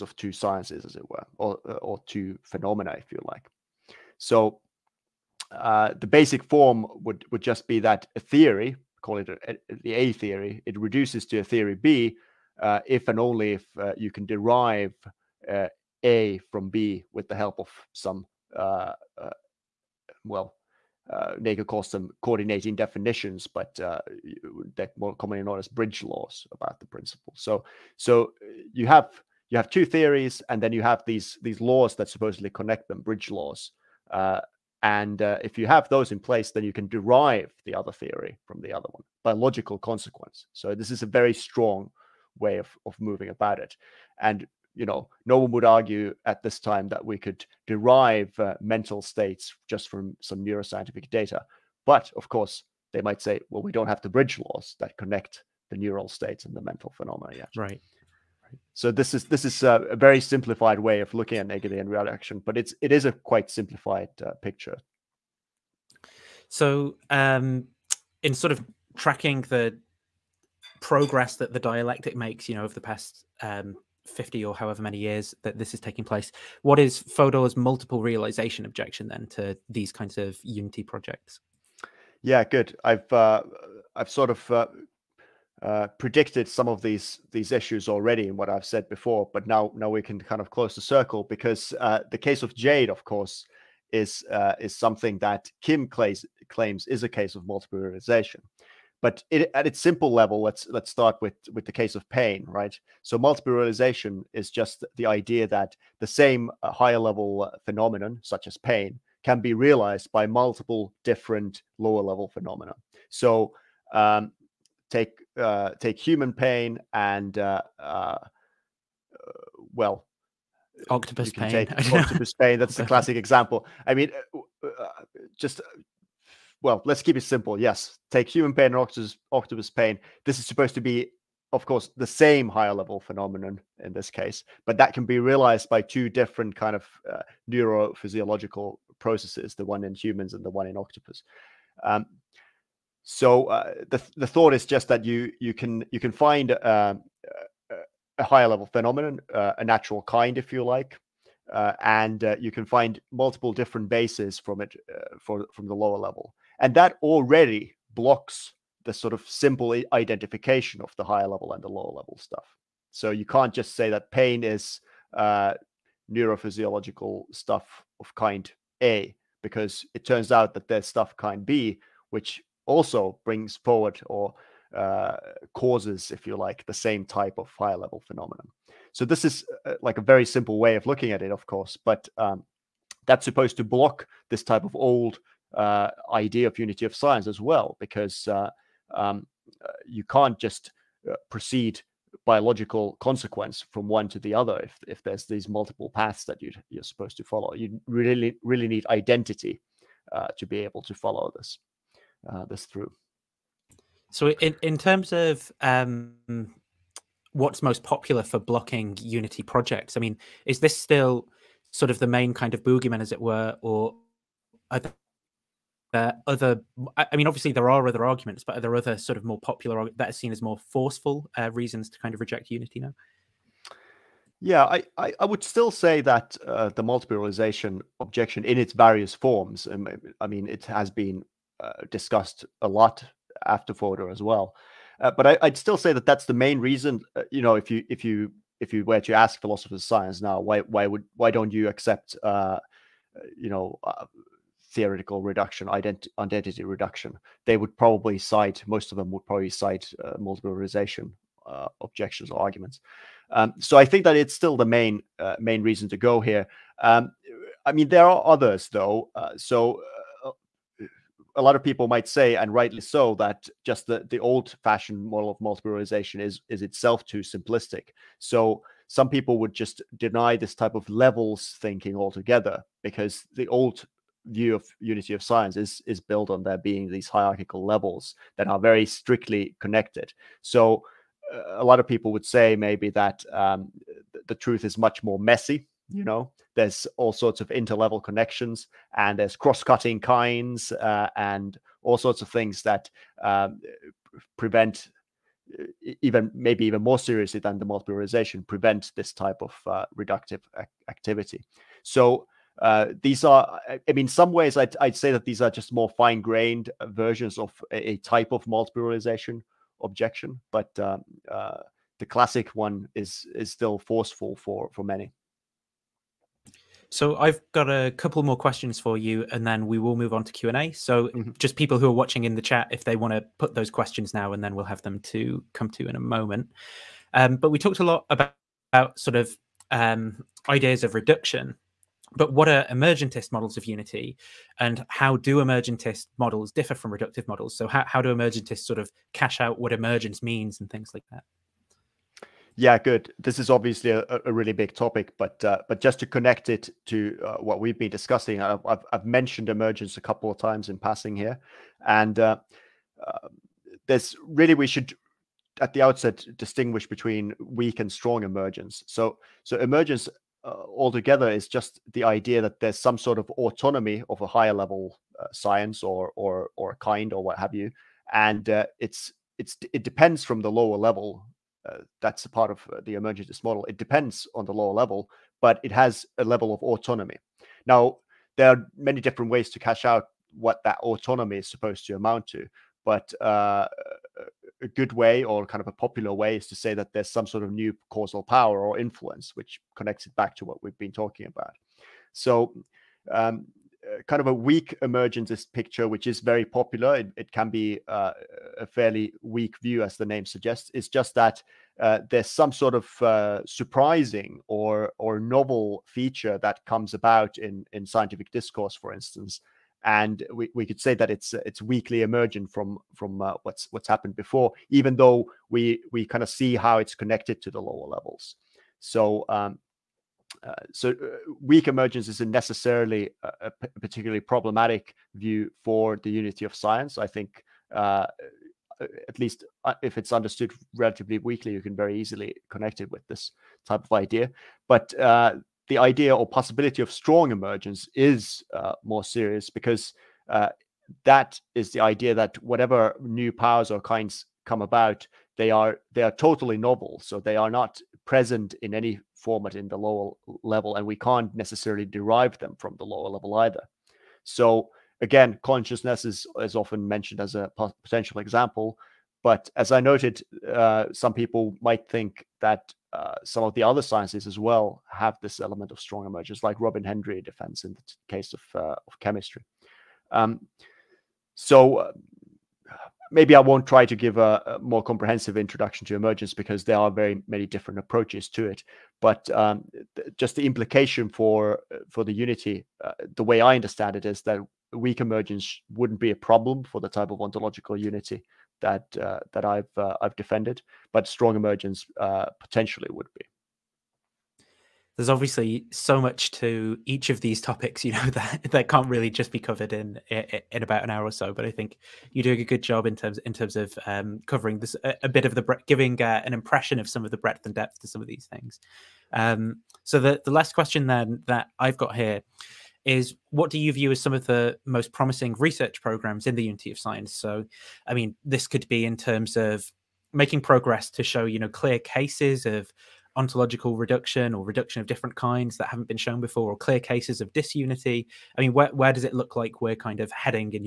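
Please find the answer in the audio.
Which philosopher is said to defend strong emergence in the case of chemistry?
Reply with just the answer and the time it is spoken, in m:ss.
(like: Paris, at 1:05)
Robin Hendry, at 7:46.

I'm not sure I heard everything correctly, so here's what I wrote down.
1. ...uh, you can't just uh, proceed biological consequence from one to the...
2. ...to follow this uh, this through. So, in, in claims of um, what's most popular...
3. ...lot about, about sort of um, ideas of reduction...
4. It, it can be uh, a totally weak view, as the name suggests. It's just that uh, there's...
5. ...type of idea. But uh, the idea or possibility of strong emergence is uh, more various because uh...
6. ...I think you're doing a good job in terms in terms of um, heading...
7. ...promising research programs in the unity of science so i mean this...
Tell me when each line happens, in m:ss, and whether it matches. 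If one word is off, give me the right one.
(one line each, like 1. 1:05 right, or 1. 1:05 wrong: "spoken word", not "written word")
1. 3:09 right
2. 3:20 wrong: "terms", not "claims"
3. 5:27 right
4. 6:36 wrong: "fairly", not "totally"
5. 7:13 wrong: "serious", not "various"
6. 8:21 wrong: "covering", not "heading"
7. 8:34 right.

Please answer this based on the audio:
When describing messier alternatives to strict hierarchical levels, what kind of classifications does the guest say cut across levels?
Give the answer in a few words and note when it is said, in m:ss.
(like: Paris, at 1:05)
cross-cutting kinds, at 4:49.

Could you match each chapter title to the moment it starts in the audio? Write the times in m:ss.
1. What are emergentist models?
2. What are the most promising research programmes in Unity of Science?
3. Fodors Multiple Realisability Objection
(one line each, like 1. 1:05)
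1. 5:22
2. 8:27
3. 1:07.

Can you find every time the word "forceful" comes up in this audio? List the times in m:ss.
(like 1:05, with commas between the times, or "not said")
3:40, 5:13.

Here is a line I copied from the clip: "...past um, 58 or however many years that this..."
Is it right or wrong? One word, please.
wrong.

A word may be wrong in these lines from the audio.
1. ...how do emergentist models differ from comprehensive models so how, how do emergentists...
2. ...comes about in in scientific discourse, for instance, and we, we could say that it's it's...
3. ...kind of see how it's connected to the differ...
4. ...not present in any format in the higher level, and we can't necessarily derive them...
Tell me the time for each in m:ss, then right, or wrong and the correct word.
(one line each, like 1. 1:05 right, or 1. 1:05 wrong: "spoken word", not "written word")
1. 5:34 wrong: "reductive", not "comprehensive"
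2. 6:46 right
3. 6:56 wrong: "lower", not "differ"
4. 7:27 wrong: "lower", not "higher".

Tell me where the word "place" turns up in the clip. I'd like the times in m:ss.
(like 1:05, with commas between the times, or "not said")
0:36, 1:16.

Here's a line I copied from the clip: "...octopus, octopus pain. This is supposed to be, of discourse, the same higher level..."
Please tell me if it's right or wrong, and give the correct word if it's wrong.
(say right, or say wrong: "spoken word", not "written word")
wrong: "course", not "discourse".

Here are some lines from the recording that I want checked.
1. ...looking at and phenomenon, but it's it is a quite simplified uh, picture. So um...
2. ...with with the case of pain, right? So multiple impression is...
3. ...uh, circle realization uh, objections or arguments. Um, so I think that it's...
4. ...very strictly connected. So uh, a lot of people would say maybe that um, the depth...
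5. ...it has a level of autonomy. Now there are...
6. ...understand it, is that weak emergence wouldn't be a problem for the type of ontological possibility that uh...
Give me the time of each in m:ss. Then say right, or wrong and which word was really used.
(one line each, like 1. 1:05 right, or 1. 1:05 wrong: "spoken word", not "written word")
1. 1:01 wrong: "reaction", not "phenomenon"
2. 1:41 wrong: "realization", not "impression"
3. 4:10 wrong: "multiple", not "circle"
4. 4:38 wrong: "truth", not "depth"
5. 6:15 right
6. 8:03 wrong: "unity", not "possibility".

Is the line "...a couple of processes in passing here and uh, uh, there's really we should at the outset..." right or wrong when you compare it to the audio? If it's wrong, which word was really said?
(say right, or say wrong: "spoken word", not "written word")
wrong: "times", not "processes".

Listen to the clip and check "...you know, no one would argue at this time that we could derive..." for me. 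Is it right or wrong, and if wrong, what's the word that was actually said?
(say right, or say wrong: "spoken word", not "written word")
right.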